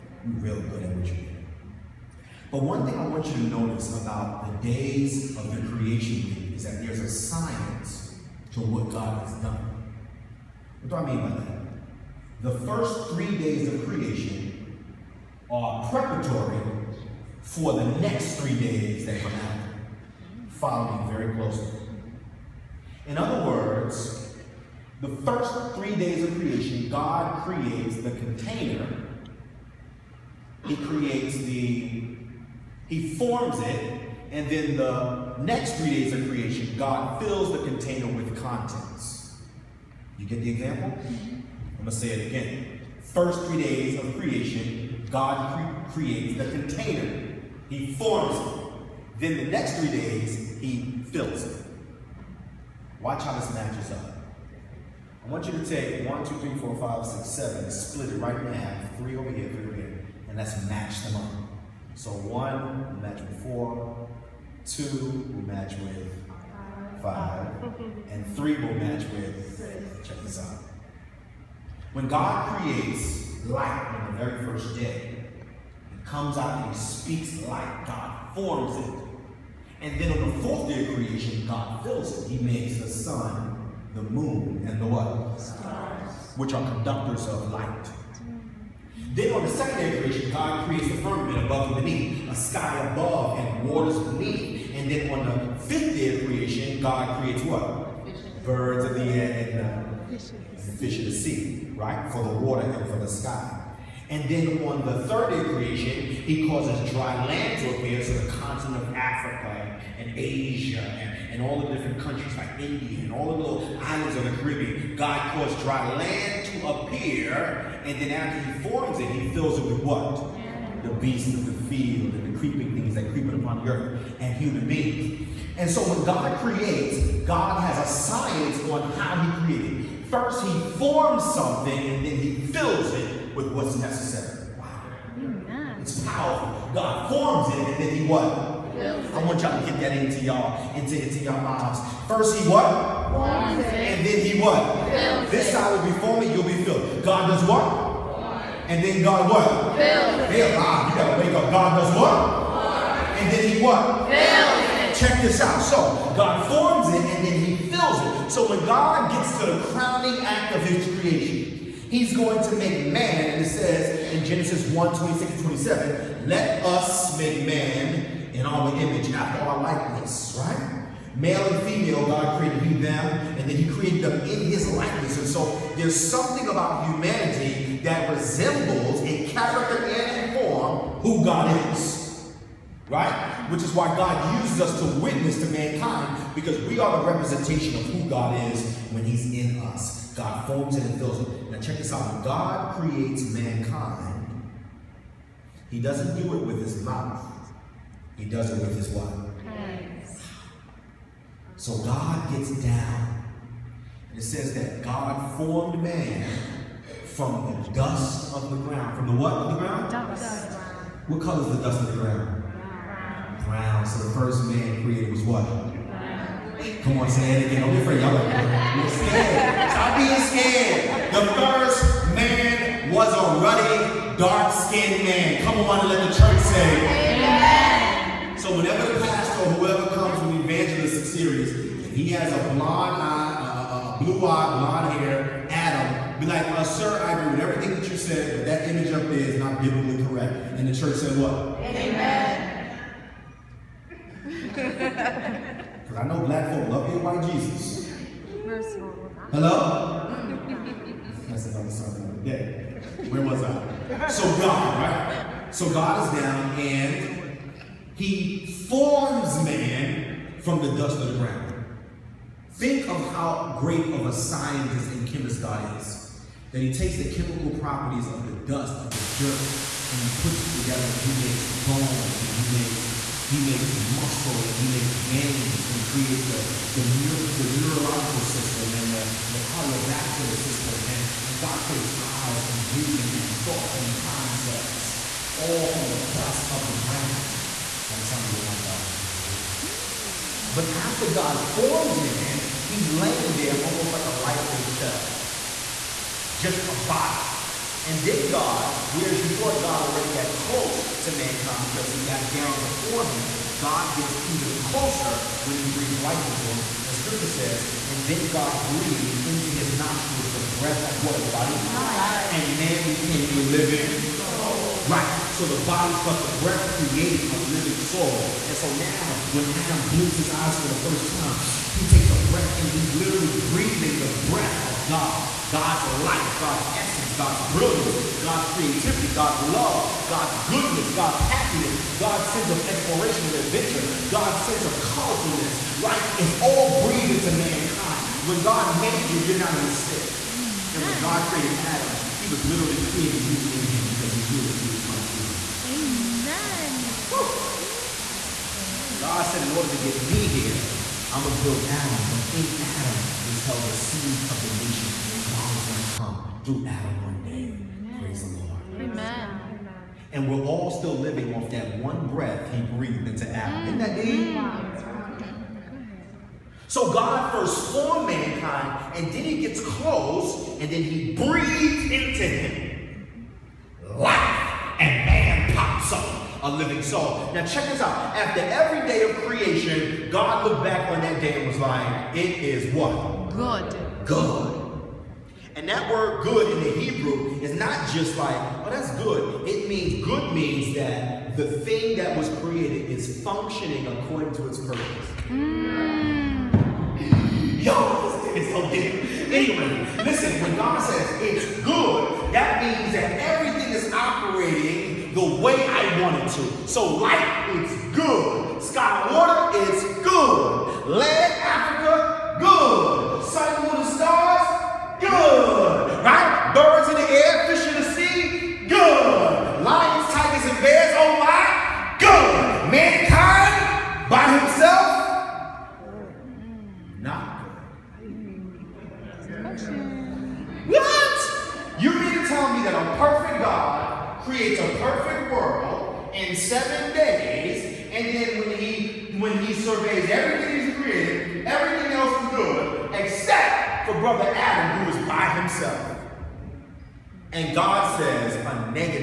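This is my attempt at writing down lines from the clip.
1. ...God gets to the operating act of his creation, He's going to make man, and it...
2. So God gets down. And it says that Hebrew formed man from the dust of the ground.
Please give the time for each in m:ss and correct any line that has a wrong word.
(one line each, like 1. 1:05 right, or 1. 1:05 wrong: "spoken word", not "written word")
1. 2:38 wrong: "crowning", not "operating"
2. 3:21 wrong: "God", not "Hebrew".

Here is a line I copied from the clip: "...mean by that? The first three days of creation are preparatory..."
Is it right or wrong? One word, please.
right.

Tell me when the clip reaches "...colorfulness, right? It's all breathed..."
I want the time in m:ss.
5:34.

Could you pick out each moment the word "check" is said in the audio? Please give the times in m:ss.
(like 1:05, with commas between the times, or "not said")
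1:10, 2:34, 3:11, 6:17.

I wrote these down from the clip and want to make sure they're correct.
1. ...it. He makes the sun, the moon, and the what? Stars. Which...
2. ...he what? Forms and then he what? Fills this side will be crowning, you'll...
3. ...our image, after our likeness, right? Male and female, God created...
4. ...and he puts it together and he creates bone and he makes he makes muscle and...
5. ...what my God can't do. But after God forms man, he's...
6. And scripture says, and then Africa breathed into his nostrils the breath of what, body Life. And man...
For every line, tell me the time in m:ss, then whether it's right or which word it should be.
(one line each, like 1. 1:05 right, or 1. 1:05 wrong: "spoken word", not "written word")
1. 1:22 right
2. 2:22 wrong: "forming", not "crowning"
3. 2:48 right
4. 4:29 wrong: "makes", not "creates"
5. 4:48 right
6. 5:06 wrong: "God", not "Africa".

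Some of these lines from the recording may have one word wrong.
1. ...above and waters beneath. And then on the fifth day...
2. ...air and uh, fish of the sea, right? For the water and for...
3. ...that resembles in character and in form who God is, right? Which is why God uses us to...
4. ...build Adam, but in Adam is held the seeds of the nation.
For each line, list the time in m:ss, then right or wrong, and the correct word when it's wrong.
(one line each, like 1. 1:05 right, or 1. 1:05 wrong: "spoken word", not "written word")
1. 1:32 right
2. 1:39 right
3. 2:57 right
4. 5:51 right.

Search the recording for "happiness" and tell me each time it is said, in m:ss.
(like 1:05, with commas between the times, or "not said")
5:31.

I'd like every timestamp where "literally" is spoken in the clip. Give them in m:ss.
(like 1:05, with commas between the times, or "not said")
5:22, 5:42.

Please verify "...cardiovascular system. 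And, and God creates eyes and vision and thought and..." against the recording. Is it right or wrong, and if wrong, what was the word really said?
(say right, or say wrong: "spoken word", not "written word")
right.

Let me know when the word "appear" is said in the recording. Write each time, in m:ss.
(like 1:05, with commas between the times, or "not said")
1:47, 1:56.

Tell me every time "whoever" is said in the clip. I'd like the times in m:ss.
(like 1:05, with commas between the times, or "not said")
3:49.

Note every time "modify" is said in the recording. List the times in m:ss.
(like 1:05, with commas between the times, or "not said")
not said.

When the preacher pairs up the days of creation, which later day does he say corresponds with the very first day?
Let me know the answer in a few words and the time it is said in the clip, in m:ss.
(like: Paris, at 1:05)
4, at 1:02.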